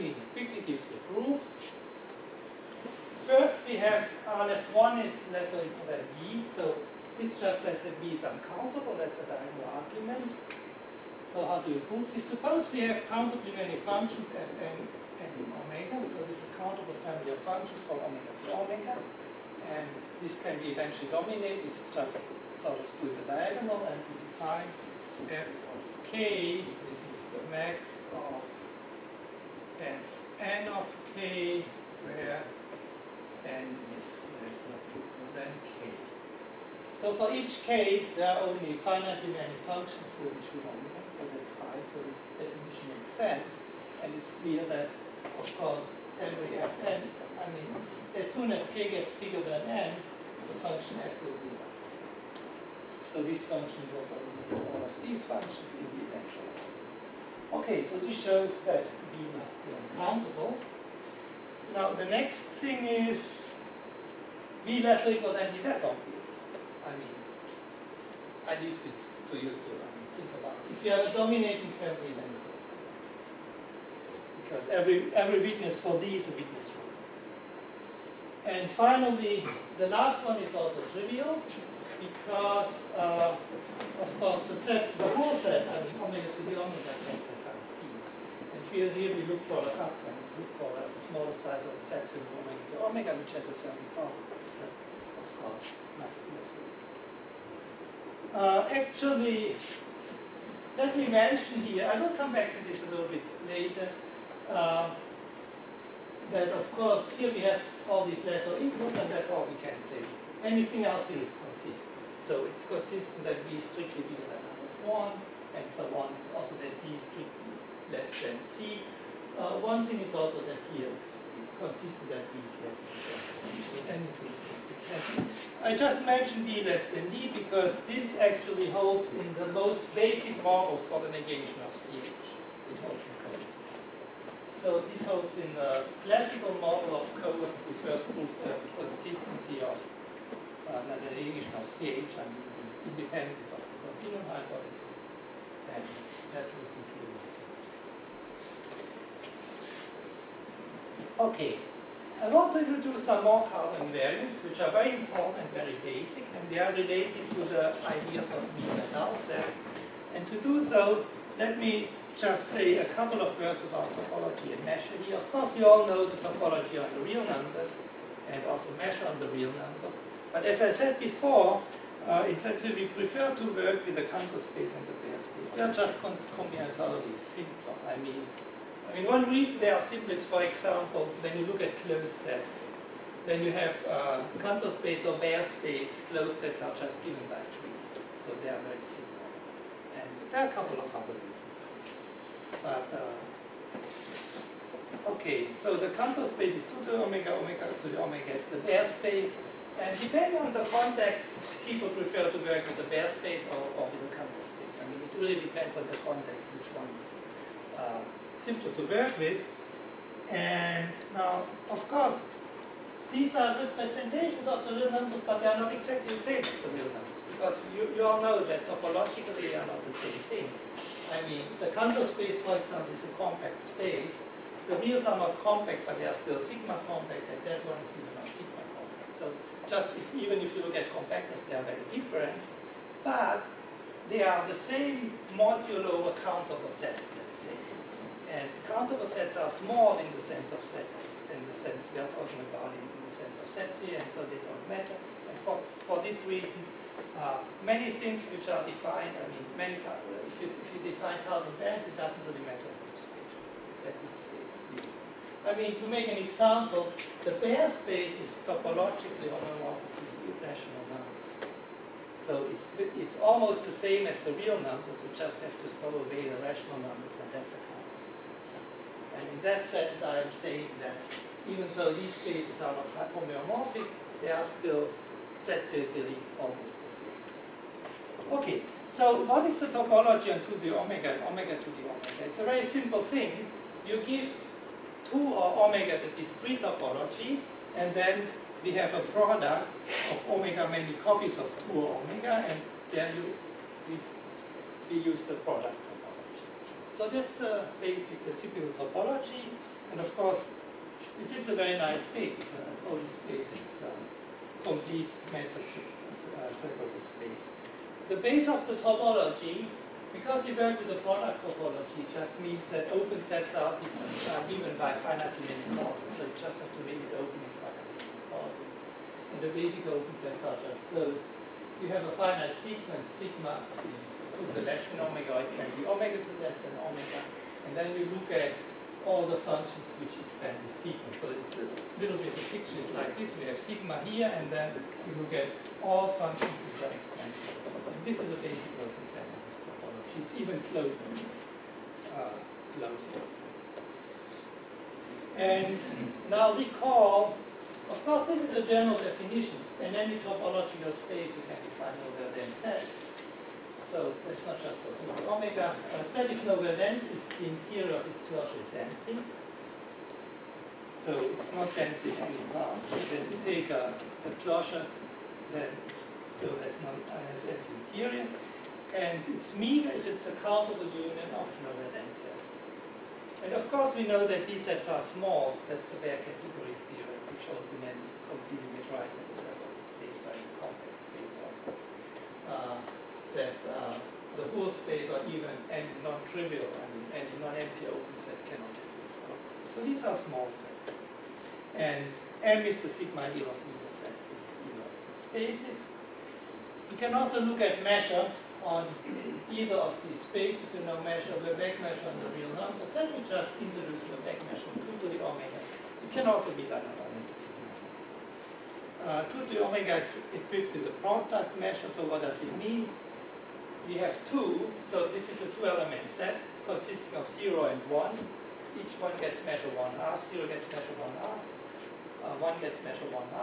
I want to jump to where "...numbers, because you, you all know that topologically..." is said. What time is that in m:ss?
3:36.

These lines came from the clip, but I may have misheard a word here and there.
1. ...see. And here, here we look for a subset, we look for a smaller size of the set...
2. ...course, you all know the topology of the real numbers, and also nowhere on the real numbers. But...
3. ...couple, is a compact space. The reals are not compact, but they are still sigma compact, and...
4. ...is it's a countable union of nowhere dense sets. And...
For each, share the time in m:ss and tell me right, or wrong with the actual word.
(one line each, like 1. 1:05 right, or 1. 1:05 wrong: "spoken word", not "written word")
1. 1:27 right
2. 2:45 wrong: "measure", not "nowhere"
3. 3:42 wrong: "example", not "couple"
4. 6:09 right.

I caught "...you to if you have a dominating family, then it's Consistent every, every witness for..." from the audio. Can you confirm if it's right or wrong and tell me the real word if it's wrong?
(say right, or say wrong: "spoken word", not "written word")
wrong: "Because", not "Consistent".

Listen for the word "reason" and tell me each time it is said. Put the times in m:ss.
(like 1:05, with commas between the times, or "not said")
2:59, 3:11, 4:06.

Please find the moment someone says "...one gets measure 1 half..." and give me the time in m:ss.
6:58.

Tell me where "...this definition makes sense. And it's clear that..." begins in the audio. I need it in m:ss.
0:42.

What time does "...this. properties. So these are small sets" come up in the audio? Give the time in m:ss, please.
6:29.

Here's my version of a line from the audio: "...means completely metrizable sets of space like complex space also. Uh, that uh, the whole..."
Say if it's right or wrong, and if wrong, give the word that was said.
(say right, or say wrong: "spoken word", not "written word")
right.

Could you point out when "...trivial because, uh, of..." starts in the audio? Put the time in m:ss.
1:20.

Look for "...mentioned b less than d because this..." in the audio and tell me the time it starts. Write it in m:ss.
2:06.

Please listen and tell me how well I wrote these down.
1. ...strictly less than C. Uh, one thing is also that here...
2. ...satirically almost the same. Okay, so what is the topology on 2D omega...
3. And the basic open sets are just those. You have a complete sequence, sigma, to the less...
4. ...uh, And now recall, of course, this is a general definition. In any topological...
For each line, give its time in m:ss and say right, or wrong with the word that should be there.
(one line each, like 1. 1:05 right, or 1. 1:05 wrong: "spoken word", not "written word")
1. 1:57 right
2. 4:35 right
3. 5:19 wrong: "finite", not "complete"
4. 5:42 right.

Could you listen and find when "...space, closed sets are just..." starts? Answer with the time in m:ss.
3:05.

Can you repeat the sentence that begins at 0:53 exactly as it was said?
So this function will be all of these functions in the eventual.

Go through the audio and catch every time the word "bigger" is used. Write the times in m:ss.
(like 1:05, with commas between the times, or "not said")
0:49, 1:54.